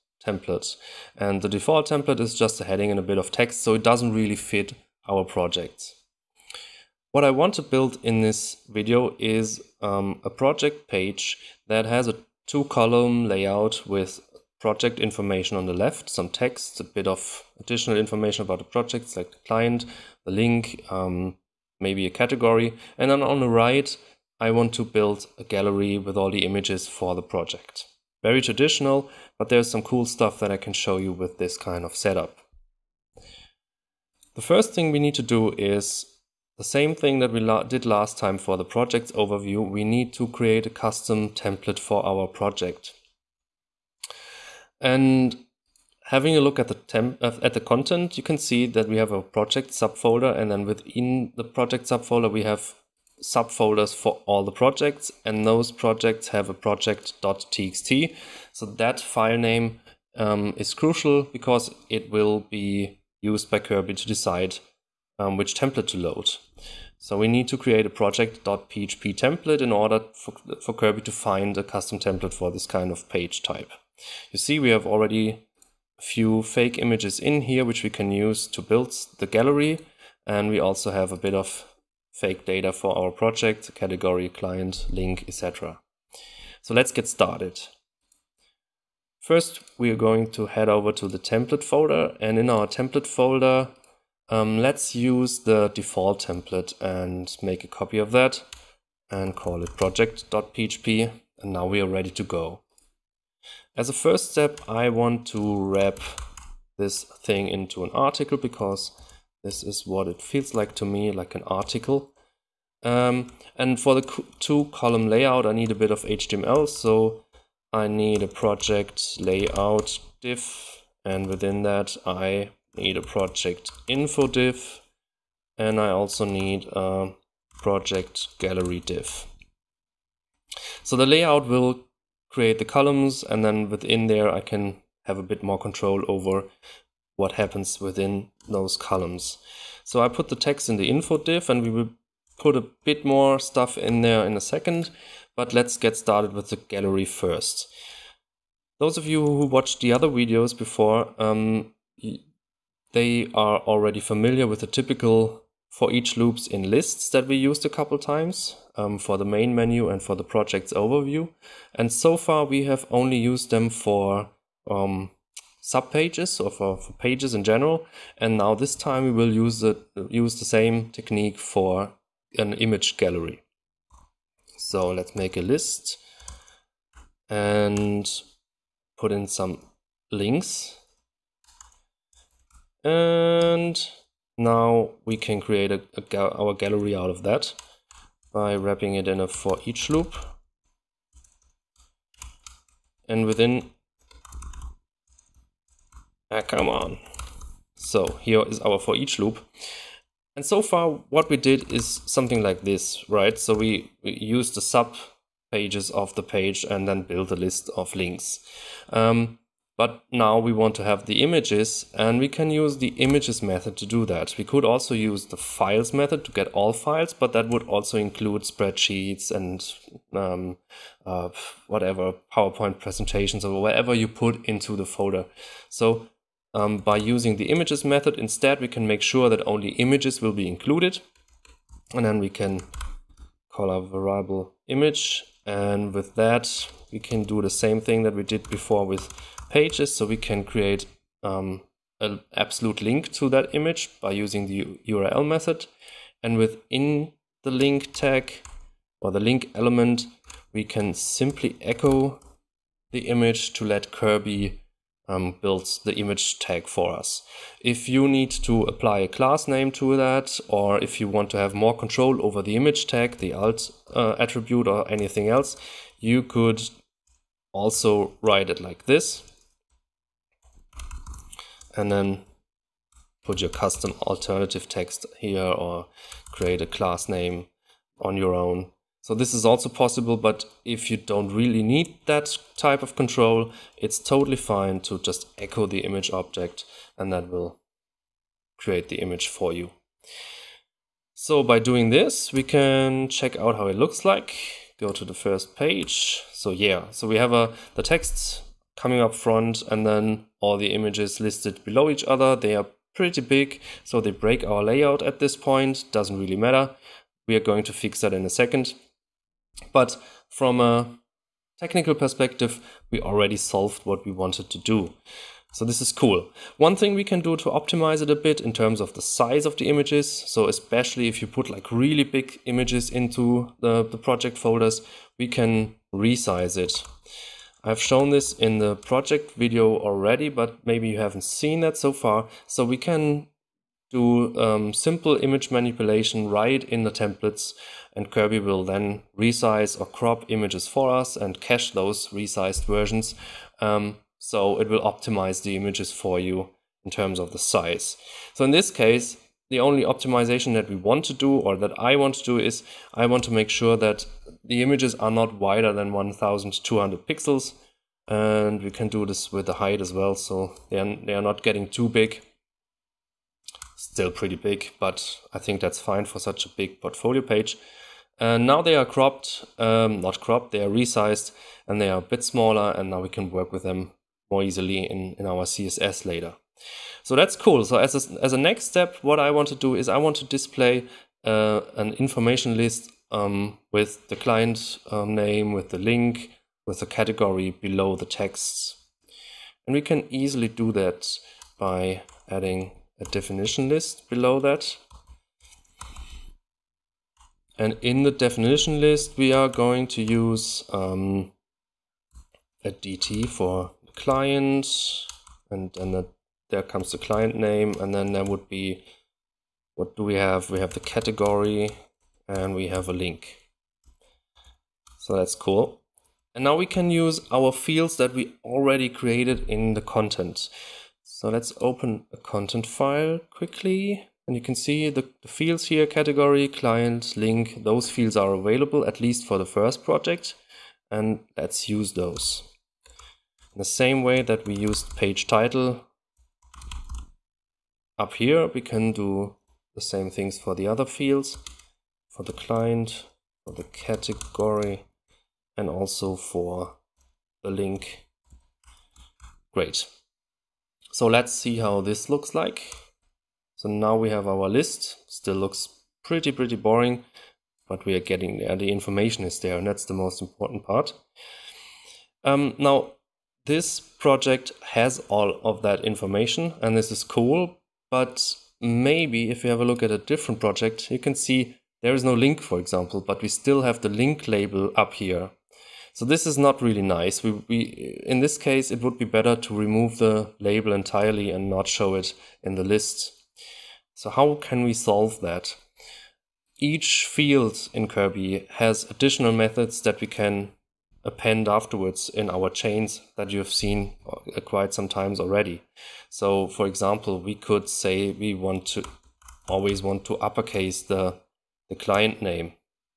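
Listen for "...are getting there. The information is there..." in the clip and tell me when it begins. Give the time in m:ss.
7:37.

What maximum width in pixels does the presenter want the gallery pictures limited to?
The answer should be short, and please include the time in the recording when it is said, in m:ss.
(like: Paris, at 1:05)
1200, at 5:55.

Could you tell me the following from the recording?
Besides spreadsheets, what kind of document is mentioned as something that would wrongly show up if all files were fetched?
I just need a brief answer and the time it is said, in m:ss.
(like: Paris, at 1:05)
PowerPoint presentations, at 3:42.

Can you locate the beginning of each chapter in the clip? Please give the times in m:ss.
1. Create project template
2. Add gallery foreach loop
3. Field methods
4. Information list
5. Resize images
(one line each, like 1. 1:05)
1. 0:31
2. 2:24
3. 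8:05
4. 6:16
5. 5:14.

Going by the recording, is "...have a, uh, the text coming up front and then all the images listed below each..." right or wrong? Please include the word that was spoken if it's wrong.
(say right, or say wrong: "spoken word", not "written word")
right.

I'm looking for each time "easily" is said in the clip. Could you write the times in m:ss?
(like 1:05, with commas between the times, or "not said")
6:14, 6:30.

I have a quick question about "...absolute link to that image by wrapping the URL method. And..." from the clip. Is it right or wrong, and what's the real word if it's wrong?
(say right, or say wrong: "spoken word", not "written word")
wrong: "using", not "wrapping".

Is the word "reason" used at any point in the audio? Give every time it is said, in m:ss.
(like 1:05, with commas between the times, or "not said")
not said.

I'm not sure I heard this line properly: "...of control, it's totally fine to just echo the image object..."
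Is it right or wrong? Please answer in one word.
right.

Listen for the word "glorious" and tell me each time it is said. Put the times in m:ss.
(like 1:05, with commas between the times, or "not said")
not said.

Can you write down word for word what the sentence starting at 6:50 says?
We have the category, and we have a link.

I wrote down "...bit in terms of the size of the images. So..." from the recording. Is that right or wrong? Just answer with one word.
right.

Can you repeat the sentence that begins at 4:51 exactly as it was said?
So by doing this, we can check out how it looks like.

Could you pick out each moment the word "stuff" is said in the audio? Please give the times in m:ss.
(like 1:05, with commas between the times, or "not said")
0:30, 2:23.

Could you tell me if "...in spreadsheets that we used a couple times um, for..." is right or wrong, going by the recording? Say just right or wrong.
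wrong.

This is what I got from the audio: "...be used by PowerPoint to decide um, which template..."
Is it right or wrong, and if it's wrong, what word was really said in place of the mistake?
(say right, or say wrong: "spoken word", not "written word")
wrong: "Kirby", not "PowerPoint".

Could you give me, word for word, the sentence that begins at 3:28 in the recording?
Um, but now we want to have the images and we can use the images method to do that.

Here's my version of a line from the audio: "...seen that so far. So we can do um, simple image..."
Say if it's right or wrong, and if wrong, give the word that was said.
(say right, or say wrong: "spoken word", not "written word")
right.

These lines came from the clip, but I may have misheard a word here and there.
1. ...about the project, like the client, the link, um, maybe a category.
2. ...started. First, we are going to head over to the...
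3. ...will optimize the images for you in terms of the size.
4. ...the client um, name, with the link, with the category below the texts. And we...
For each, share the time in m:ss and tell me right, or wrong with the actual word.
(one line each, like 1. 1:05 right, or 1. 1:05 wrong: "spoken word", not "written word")
1. 0:18 right
2. 1:27 right
3. 5:44 right
4. 6:24 right.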